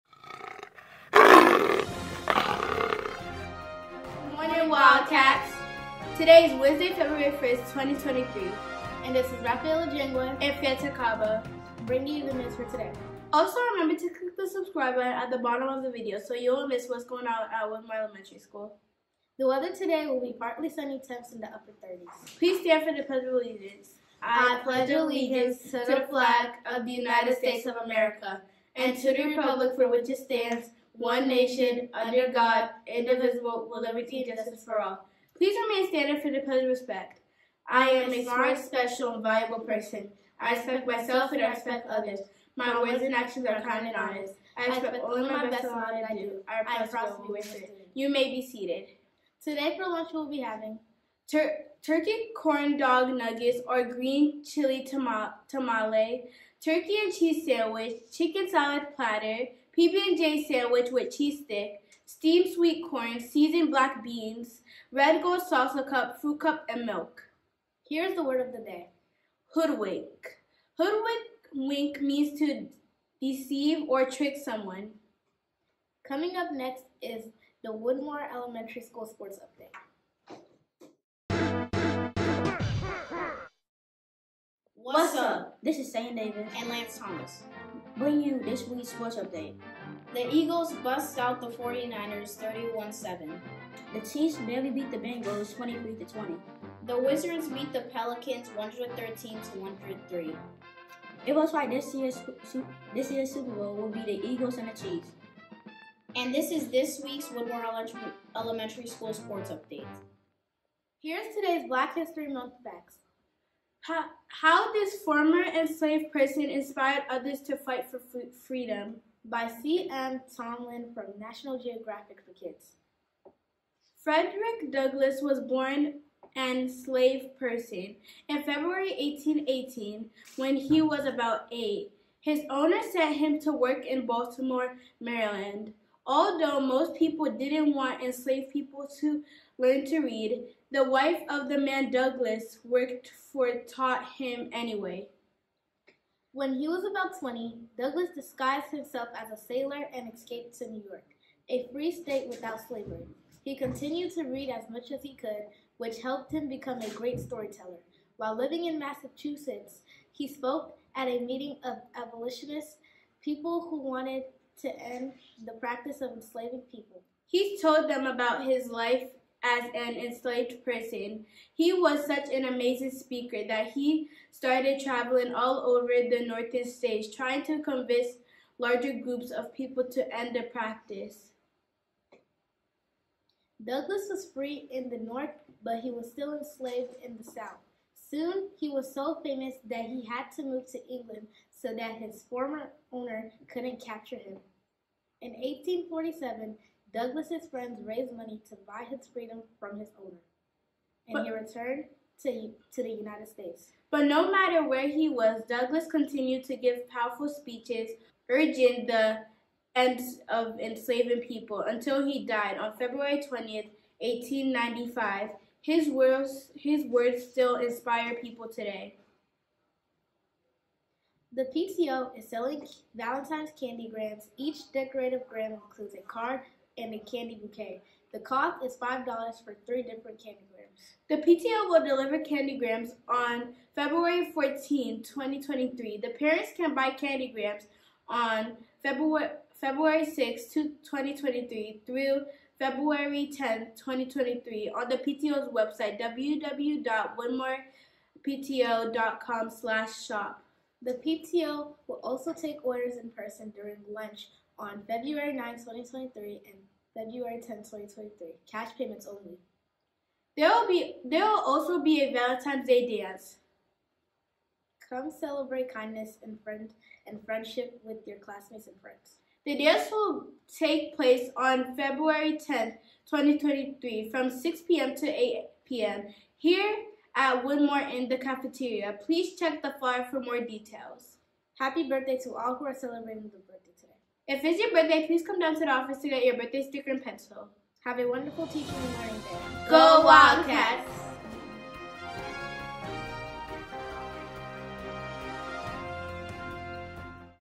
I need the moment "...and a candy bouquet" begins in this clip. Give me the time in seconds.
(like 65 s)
226 s.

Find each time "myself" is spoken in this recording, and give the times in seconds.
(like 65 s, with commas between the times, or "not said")
40 s.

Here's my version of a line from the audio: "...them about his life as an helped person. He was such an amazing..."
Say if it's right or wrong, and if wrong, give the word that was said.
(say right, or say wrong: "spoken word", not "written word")
wrong: "enslaved", not "helped".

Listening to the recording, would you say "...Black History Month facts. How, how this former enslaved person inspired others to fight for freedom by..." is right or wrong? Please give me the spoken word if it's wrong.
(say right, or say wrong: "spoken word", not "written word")
right.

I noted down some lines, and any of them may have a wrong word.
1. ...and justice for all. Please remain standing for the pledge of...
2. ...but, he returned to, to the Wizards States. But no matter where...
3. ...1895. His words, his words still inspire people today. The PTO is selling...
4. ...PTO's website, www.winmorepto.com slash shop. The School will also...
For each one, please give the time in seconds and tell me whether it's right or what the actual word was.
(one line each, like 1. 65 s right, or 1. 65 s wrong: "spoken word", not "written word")
1. 34 s right
2. 201 s wrong: "United", not "Wizards"
3. 213 s right
4. 244 s wrong: "PTO", not "School".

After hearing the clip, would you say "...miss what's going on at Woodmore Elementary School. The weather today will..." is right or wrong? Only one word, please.
right.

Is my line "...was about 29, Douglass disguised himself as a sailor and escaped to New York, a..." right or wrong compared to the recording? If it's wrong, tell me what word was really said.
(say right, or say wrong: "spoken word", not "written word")
wrong: "20", not "29".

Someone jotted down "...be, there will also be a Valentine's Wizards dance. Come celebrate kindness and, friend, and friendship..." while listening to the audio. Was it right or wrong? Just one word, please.
wrong.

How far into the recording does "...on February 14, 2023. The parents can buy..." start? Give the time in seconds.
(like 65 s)
233 s.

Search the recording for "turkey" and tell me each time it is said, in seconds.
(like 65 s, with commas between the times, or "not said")
51 s, 56 s.